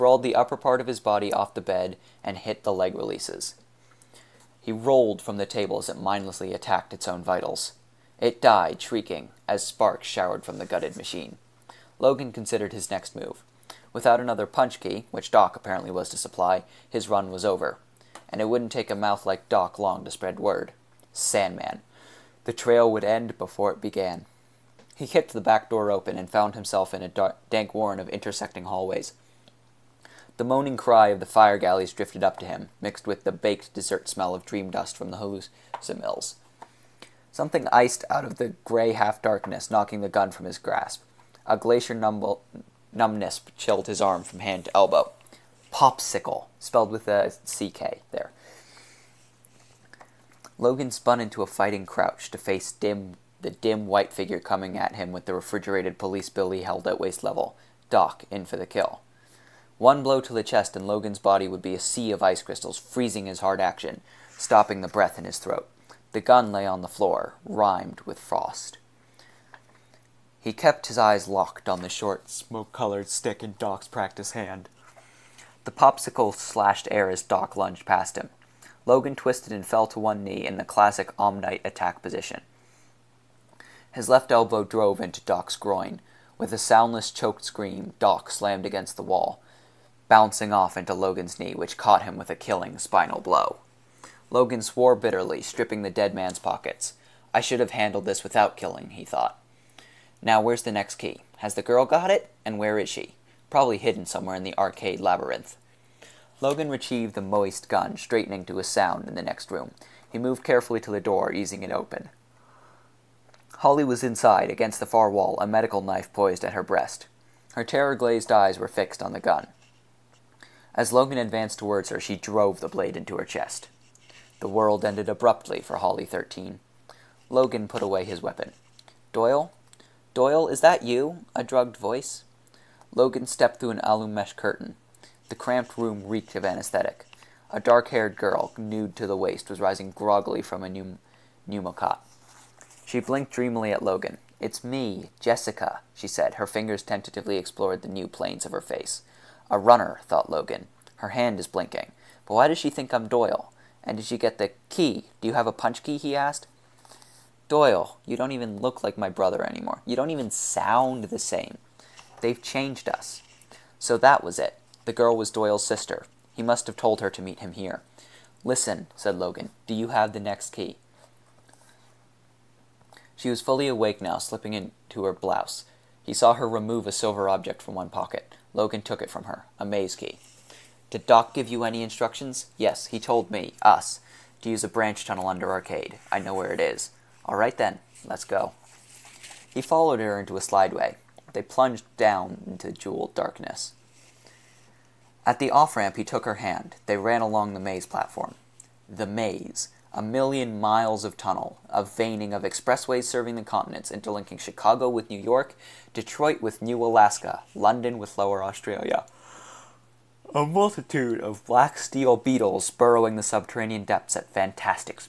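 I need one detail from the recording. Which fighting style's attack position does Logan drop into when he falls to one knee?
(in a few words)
Omnite.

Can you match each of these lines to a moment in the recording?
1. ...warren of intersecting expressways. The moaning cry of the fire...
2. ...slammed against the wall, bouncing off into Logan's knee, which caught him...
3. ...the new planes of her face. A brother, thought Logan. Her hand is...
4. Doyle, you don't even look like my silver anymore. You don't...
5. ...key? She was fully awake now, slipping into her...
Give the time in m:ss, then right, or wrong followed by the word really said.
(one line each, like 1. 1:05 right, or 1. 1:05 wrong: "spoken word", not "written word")
1. 0:27 wrong: "hallways", not "expressways"
2. 1:28 right
3. 2:27 wrong: "runner", not "brother"
4. 2:37 wrong: "brother", not "silver"
5. 2:50 right.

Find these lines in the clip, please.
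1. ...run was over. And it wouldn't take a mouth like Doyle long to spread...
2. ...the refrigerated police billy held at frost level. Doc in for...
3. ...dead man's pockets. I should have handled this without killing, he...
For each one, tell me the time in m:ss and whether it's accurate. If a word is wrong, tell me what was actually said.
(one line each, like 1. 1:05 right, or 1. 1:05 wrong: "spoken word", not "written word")
1. 0:17 wrong: "Doc", not "Doyle"
2. 0:55 wrong: "waist", not "frost"
3. 1:35 right.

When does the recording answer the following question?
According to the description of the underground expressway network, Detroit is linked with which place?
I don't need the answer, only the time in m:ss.
3:26.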